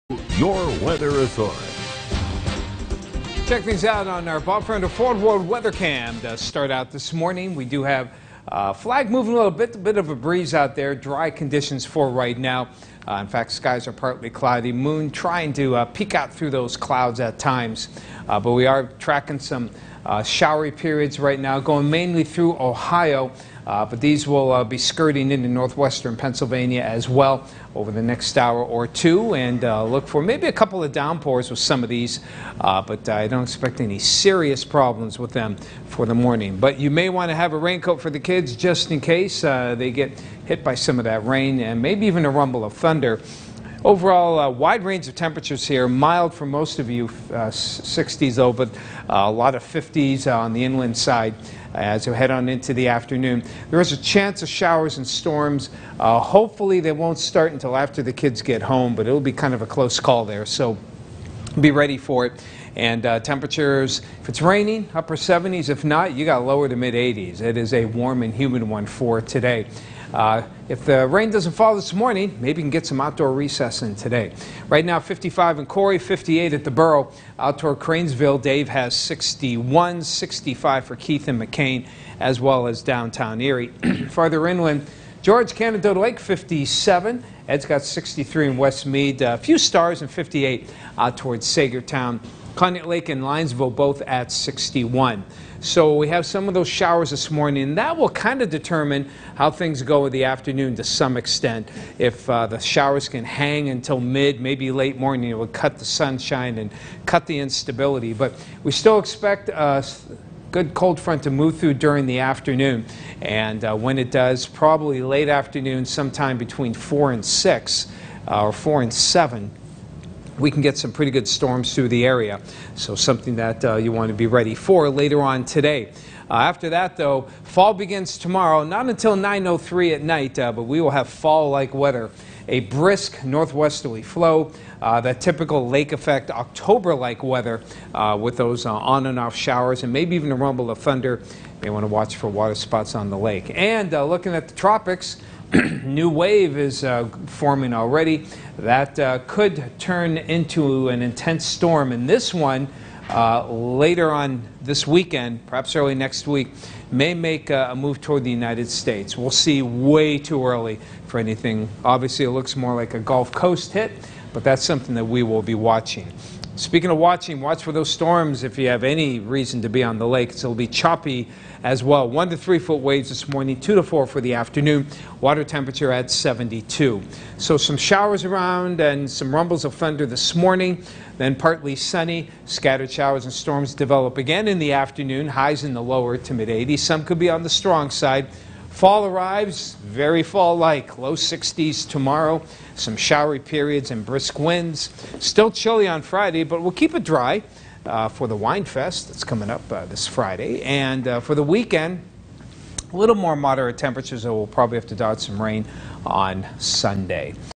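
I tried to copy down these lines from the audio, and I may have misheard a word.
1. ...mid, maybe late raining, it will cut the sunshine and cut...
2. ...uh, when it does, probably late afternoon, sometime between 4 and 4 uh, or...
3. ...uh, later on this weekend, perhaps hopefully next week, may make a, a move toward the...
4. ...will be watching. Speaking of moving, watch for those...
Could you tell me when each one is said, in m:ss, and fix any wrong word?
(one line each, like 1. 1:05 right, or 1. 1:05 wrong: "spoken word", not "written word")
1. 1:43 wrong: "morning", not "raining"
2. 1:53 wrong: "6", not "4"
3. 2:33 wrong: "early", not "hopefully"
4. 2:45 wrong: "watching", not "moving".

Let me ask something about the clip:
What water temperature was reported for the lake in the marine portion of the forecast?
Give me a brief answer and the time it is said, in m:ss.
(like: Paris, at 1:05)
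72, at 2:56.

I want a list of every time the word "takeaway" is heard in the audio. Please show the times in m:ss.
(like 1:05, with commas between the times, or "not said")
not said.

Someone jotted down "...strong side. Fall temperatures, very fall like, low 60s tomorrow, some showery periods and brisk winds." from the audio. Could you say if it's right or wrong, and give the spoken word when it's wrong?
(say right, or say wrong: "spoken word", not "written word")
wrong: "arrives", not "temperatures".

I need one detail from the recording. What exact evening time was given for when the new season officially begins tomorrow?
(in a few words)
9:03.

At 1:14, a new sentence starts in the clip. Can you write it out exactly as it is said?
Right now, 55 in Corey, 58 at the Borough.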